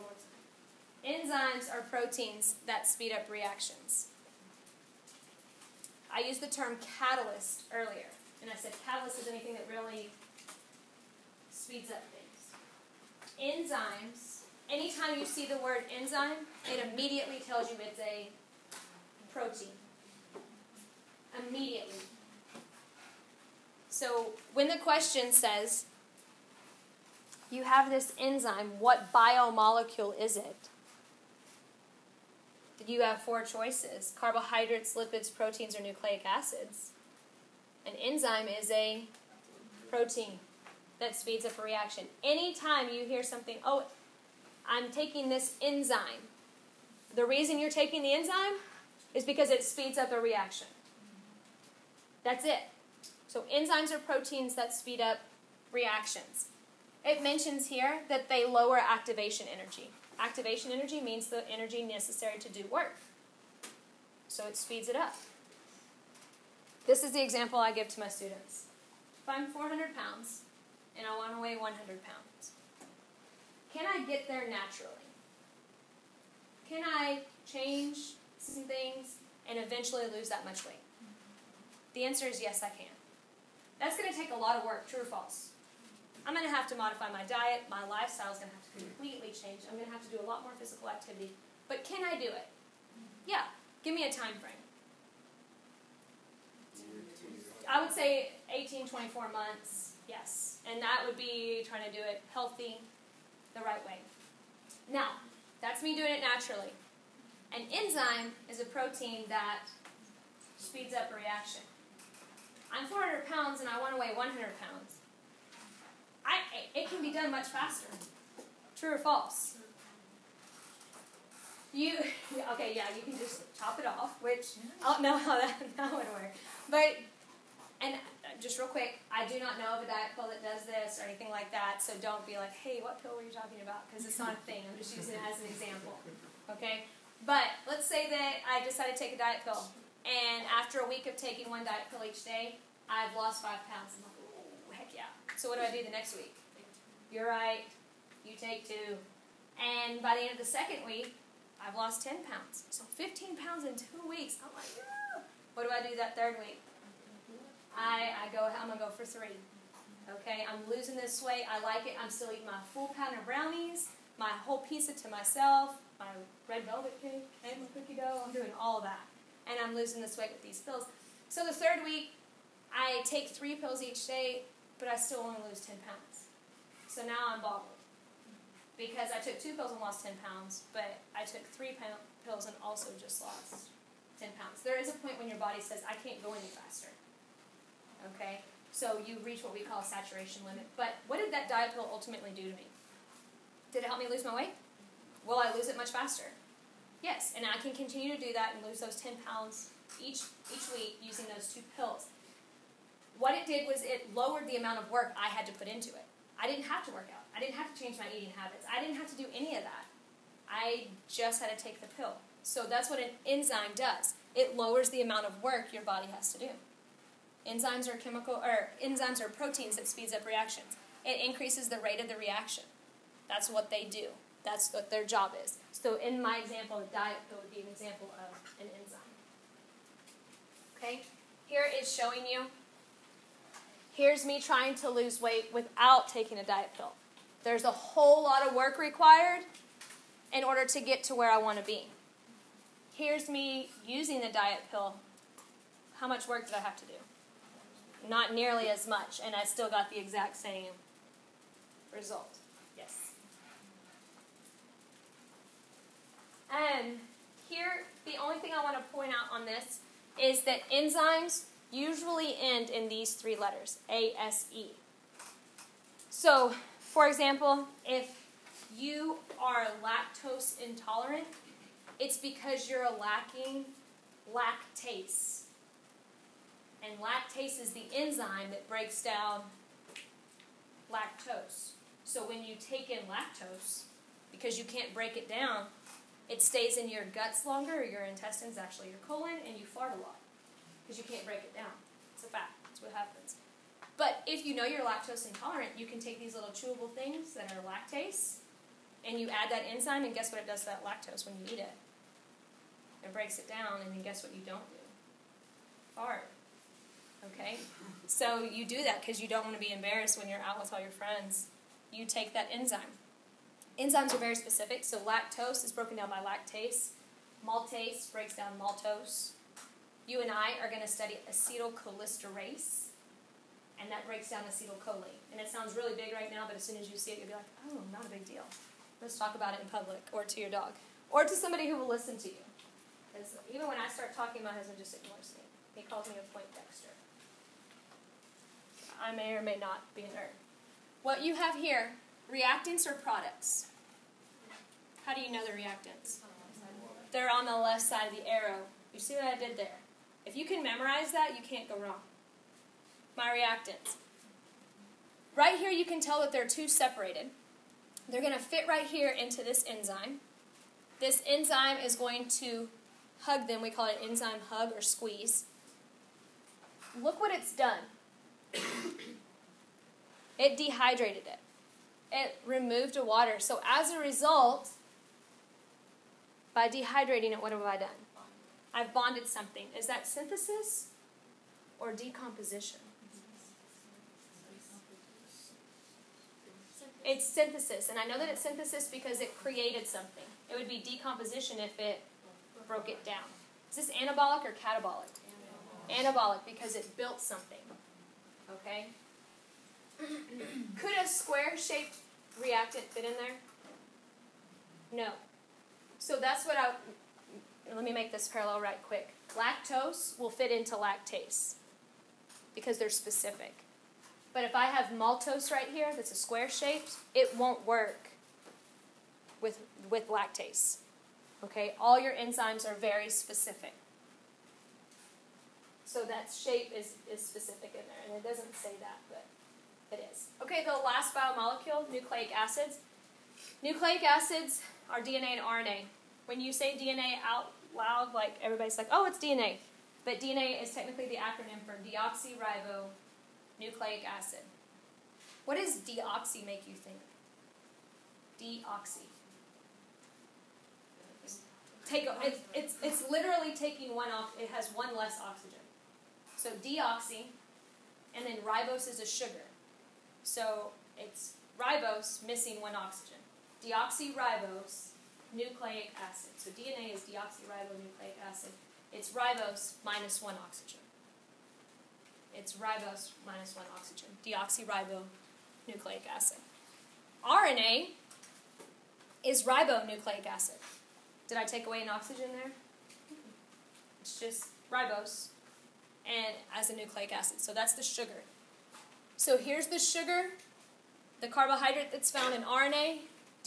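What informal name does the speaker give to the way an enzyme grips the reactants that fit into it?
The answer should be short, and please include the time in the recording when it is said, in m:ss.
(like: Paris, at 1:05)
enzyme hug, at 6:04.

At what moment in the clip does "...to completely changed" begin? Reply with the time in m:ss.
1:28.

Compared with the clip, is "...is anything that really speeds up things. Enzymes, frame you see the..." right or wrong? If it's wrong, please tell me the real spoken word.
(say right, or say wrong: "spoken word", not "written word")
wrong: "anytime", not "frame".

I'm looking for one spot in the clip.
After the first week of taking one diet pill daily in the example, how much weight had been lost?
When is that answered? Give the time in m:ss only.
2:23.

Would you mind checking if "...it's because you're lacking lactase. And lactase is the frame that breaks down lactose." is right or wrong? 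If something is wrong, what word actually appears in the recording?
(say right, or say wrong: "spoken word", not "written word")
wrong: "enzyme", not "frame".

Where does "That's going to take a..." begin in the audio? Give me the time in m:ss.
1:23.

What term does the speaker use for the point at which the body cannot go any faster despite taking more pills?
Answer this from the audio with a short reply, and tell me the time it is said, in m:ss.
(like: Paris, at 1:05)
saturation limit, at 3:09.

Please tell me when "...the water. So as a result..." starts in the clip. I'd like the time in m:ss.
6:12.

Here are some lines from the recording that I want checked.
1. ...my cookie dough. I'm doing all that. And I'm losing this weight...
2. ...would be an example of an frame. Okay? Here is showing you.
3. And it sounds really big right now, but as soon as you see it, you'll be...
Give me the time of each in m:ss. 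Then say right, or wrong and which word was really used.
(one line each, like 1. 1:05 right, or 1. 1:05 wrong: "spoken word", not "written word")
1. 2:47 right
2. 3:47 wrong: "enzyme", not "frame"
3. 5:25 right.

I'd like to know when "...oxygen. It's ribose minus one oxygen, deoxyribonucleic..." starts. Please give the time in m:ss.
7:50.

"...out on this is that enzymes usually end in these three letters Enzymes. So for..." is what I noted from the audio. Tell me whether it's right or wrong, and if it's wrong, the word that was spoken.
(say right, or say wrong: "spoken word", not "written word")
wrong: "ASE", not "Enzymes".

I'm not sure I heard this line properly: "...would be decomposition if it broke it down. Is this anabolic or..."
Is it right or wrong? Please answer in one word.
right.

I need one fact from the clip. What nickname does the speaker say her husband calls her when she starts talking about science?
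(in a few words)
point dexter.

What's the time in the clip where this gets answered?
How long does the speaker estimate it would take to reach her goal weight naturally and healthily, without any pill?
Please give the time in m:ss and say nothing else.
1:38.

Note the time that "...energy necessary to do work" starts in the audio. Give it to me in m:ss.
1:01.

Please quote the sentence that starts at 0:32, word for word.
you have four choices carbohydrates, lipids, proteins, or nucleic acids.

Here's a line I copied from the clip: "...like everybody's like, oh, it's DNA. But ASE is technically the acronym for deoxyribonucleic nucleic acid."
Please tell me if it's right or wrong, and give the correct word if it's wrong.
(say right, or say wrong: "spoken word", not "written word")
wrong: "DNA", not "ASE".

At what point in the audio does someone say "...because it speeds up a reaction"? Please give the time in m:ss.
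0:49.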